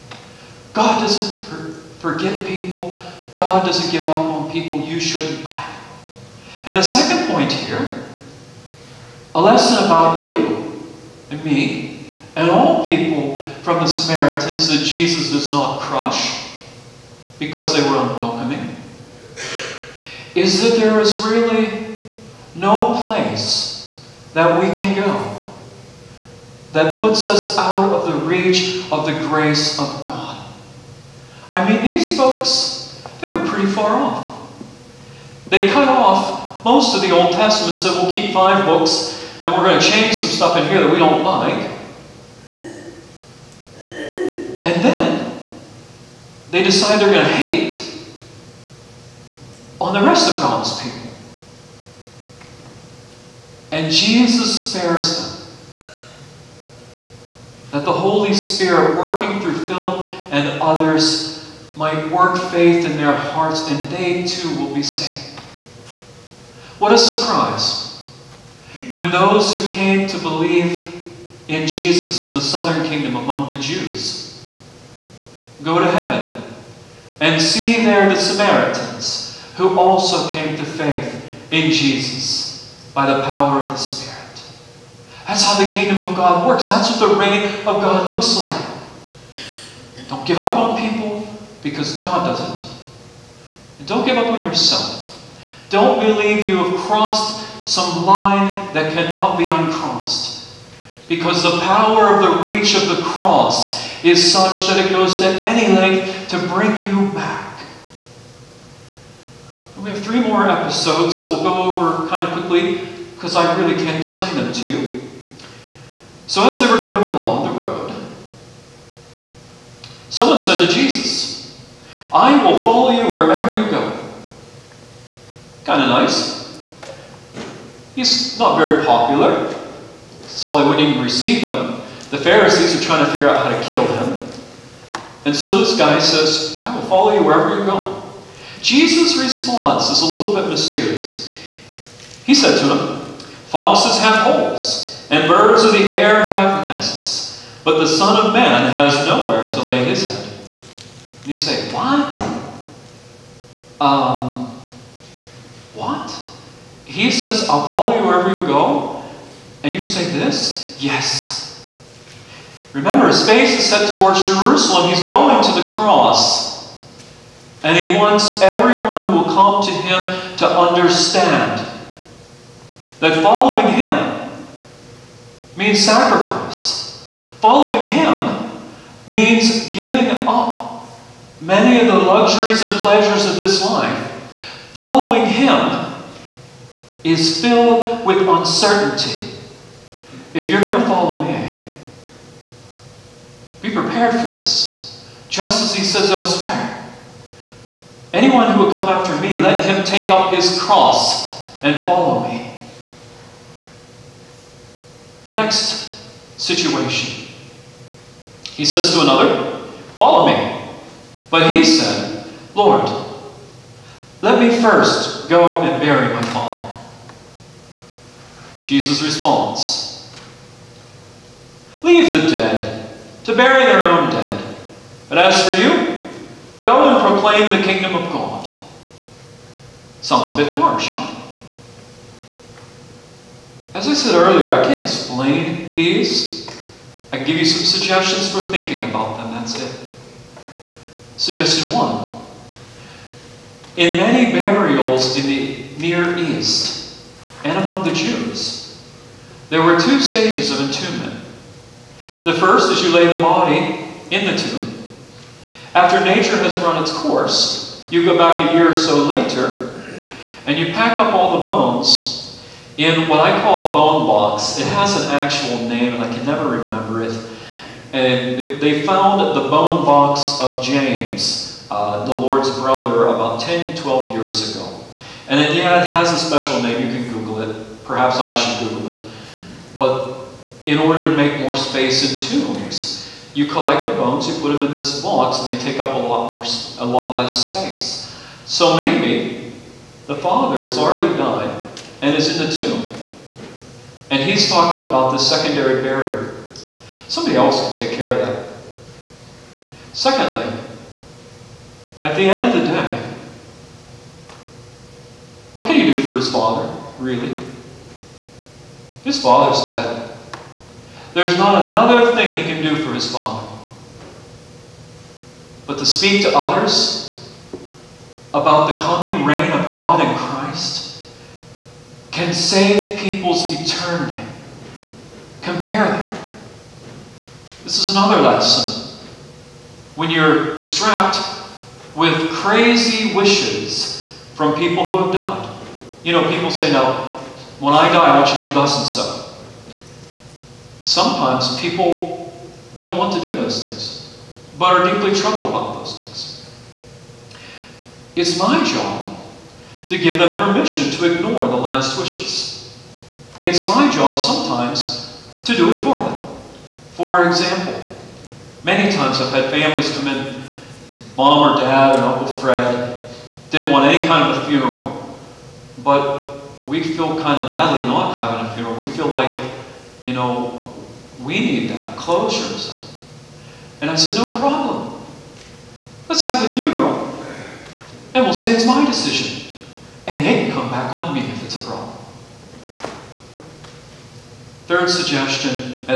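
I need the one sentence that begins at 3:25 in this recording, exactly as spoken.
The next situation, he says to another, Follow me.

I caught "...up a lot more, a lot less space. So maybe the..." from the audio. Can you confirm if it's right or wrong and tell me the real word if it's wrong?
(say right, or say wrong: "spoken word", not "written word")
right.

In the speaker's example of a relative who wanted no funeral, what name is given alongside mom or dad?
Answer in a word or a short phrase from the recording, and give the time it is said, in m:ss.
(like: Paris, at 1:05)
Uncle Fred, at 6:02.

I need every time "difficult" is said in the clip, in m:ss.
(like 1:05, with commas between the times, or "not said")
not said.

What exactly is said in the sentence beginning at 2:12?
The Pharisees are trying to figure out how to kill him.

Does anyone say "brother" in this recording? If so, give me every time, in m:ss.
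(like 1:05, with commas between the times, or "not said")
4:32.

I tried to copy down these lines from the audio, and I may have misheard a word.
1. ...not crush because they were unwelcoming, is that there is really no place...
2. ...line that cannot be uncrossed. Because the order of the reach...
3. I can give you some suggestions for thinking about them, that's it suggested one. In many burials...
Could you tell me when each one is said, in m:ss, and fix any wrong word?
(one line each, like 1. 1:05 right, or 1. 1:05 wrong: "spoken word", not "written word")
1. 0:15 right
2. 1:38 wrong: "power", not "order"
3. 3:57 right.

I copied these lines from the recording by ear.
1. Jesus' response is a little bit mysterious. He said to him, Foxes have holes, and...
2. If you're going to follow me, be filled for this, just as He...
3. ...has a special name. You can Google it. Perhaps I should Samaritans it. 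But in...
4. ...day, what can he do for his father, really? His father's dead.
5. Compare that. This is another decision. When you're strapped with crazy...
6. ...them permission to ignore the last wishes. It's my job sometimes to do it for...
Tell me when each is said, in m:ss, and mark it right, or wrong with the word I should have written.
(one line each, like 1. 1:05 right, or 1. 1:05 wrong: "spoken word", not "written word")
1. 2:18 right
2. 3:10 wrong: "prepared", not "filled"
3. 4:35 wrong: "Google", not "Samaritans"
4. 5:02 right
5. 5:25 wrong: "lesson", not "decision"
6. 5:50 right.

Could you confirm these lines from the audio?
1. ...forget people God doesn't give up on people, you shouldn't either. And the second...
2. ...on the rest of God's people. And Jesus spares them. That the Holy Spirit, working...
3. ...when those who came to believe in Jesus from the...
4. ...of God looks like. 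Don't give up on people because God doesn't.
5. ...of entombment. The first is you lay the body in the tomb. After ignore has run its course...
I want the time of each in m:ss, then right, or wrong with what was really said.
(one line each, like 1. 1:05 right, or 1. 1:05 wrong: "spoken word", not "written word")
1. 0:01 right
2. 0:49 right
3. 1:08 right
4. 1:27 right
5. 4:10 wrong: "nature", not "ignore".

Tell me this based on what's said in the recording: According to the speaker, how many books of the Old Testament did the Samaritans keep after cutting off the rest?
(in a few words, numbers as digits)
5.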